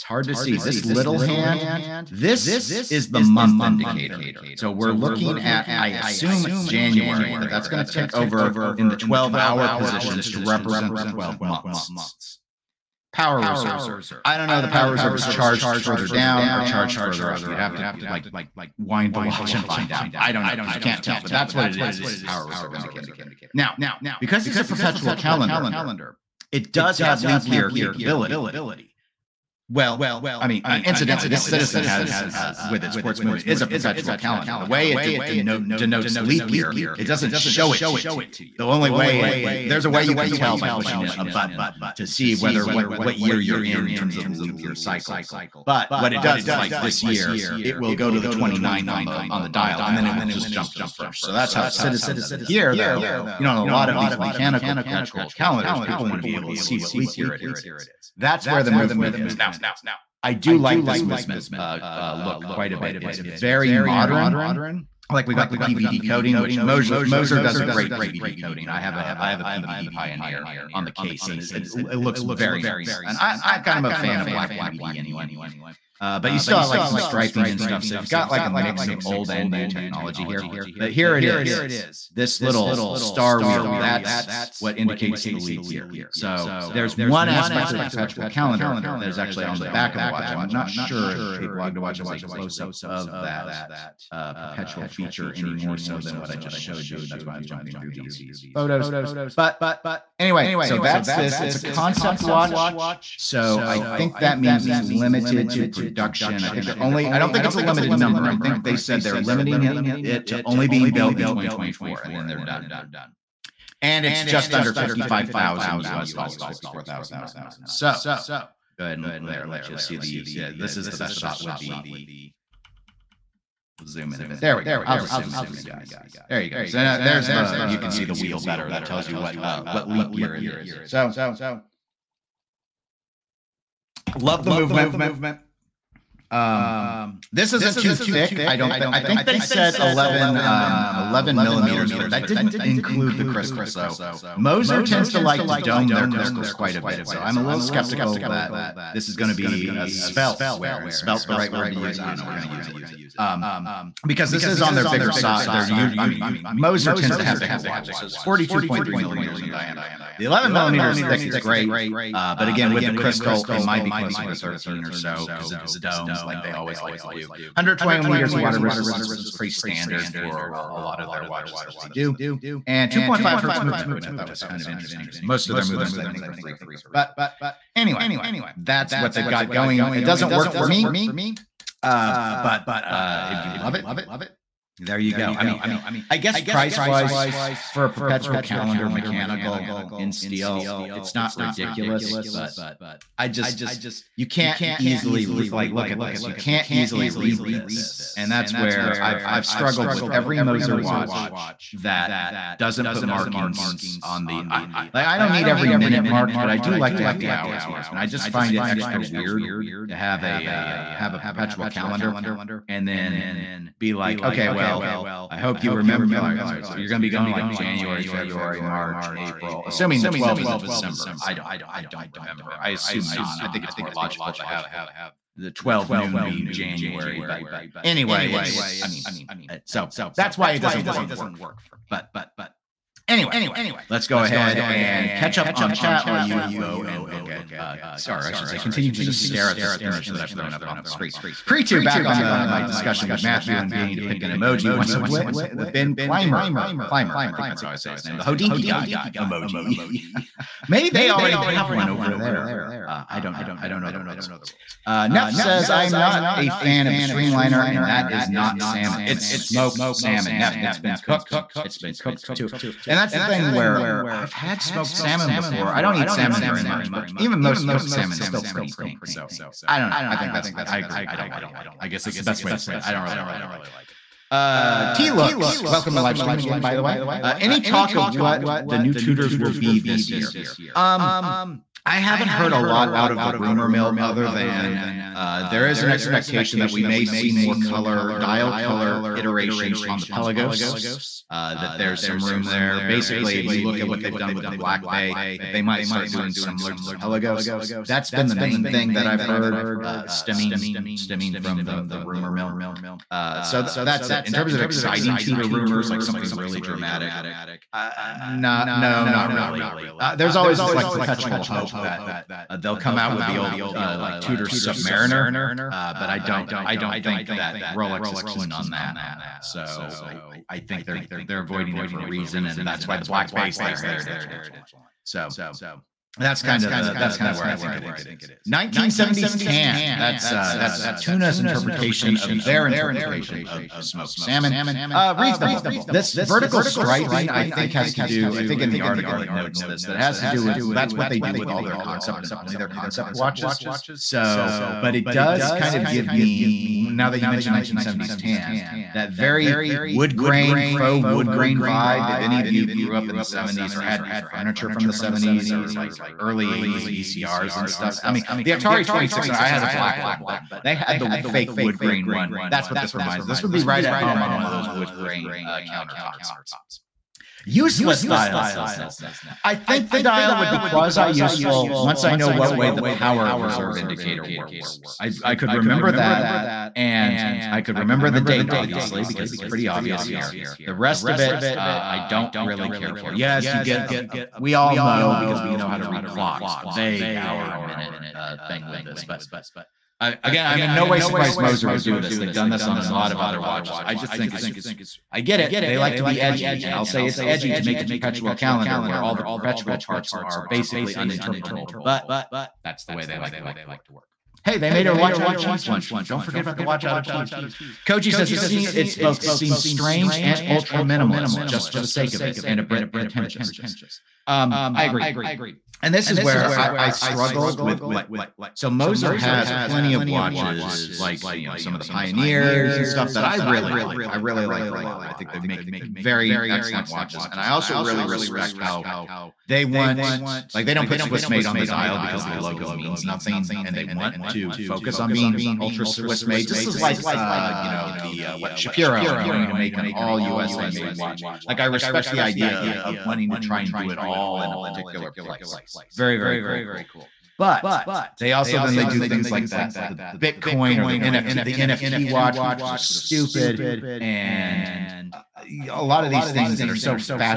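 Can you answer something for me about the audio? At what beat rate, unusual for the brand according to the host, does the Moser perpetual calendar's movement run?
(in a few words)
2.5 hertz.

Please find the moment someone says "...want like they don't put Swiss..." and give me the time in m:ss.
7:09.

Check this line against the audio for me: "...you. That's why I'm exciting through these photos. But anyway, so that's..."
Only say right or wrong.
wrong.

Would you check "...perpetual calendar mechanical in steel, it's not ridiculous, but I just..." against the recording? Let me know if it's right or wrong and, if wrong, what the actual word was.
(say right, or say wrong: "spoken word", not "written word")
right.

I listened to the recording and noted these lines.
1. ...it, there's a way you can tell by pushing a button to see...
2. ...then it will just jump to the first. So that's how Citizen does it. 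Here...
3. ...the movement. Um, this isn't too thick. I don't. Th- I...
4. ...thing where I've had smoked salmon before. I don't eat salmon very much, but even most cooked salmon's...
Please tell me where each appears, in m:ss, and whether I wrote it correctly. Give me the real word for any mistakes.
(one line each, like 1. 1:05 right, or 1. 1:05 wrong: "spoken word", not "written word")
1. 0:39 right
2. 0:49 right
3. 2:14 right
4. 4:23 right.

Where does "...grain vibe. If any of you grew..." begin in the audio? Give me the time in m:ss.
5:51.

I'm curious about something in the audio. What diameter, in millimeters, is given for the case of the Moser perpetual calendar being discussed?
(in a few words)
42.3 millimeters.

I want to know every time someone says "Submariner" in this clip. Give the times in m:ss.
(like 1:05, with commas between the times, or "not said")
5:14.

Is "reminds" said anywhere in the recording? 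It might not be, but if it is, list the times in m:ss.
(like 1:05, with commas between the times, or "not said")
6:02.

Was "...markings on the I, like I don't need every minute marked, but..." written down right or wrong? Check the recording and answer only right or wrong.
right.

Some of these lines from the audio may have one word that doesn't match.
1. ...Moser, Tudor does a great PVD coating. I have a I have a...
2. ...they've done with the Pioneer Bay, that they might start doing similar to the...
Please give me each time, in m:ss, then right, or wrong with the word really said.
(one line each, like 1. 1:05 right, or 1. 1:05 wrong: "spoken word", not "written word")
1. 1:06 wrong: "Moser", not "Tudor"
2. 4:54 wrong: "Black", not "Pioneer".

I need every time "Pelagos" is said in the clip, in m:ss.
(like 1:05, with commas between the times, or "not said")
4:50, 4:56.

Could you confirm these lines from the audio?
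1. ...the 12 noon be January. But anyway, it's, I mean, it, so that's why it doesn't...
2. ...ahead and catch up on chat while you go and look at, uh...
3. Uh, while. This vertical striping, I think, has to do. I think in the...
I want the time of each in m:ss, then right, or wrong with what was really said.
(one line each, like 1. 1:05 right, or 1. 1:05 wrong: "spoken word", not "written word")
1. 3:45 right
2. 3:54 right
3. 5:34 wrong: "reasonable", not "while".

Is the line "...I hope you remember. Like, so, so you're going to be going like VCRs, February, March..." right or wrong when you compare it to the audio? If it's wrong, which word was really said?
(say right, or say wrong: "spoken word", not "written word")
wrong: "January", not "VCRs".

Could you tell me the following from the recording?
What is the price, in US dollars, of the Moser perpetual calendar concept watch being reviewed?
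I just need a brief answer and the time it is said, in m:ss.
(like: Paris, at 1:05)
54,900, at 1:56.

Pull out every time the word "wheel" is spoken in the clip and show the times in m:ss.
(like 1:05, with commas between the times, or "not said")
1:23, 2:08.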